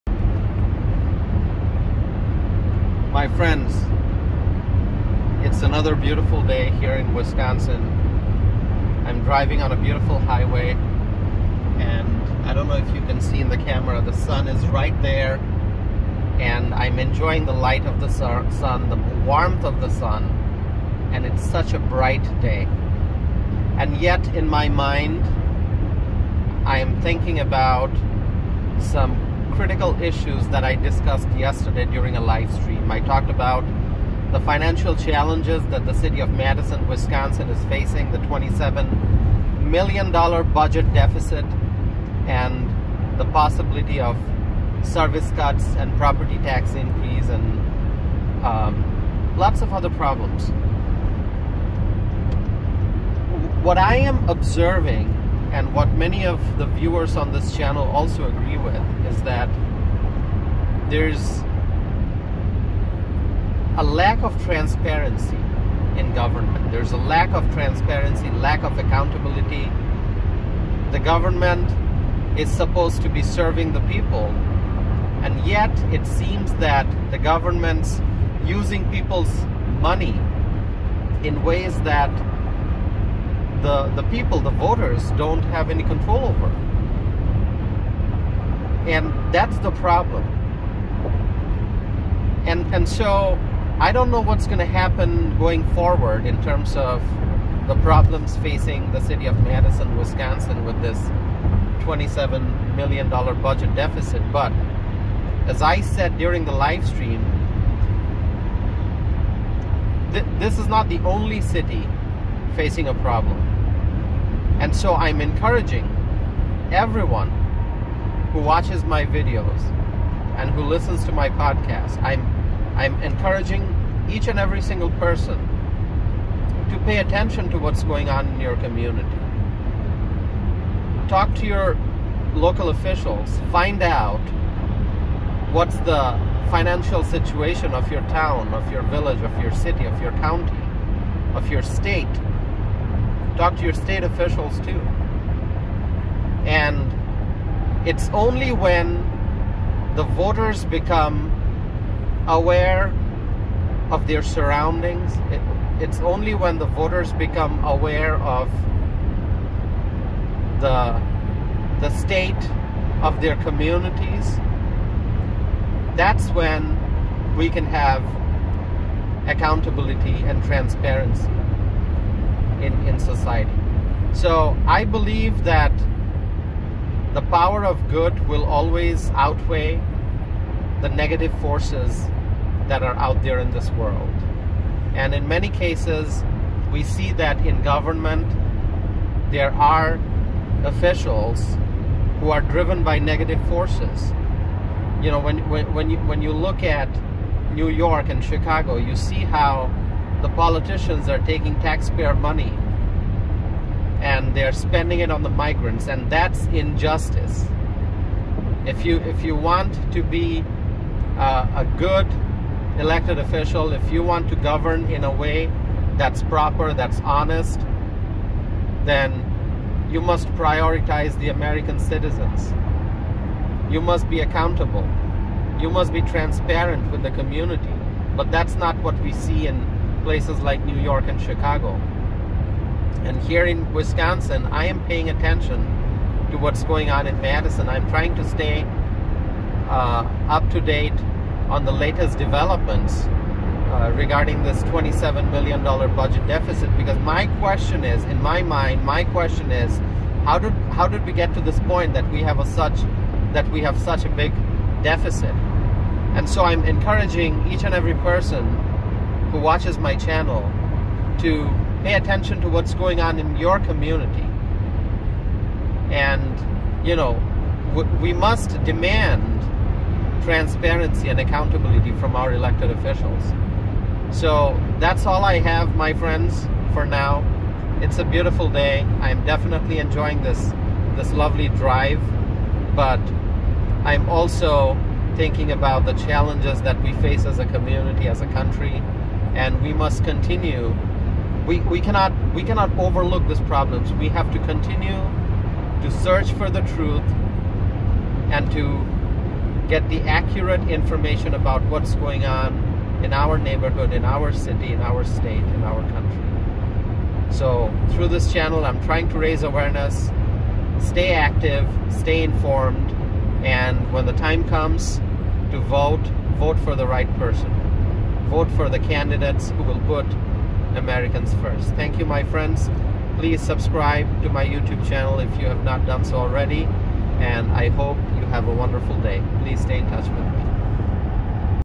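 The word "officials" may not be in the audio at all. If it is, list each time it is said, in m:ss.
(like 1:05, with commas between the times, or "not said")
2:12, 2:24, 3:10, 3:33, 4:32.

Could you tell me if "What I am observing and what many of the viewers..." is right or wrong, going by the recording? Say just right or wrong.
right.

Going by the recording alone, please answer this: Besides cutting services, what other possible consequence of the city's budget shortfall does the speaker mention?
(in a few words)
property tax increase.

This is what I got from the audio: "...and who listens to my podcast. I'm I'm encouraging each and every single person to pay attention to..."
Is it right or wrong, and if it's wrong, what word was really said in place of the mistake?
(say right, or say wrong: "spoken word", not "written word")
right.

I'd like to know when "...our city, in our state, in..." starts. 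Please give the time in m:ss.
5:04.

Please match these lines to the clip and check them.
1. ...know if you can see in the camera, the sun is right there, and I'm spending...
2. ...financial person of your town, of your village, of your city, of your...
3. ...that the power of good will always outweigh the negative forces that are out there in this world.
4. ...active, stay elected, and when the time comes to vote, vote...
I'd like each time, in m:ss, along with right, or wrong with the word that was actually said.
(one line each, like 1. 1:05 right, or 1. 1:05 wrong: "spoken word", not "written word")
1. 0:12 wrong: "enjoying", not "spending"
2. 2:16 wrong: "situation", not "person"
3. 2:55 right
4. 5:11 wrong: "informed", not "elected".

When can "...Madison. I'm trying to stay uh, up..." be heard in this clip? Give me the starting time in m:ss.
3:57.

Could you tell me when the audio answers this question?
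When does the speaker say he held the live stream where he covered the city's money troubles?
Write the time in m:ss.
0:31.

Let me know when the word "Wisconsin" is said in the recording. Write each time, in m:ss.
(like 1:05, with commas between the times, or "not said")
0:07, 0:36, 1:39, 3:53.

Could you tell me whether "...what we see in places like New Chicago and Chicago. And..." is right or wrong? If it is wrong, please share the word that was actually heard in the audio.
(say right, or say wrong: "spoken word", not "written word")
wrong: "York", not "Chicago".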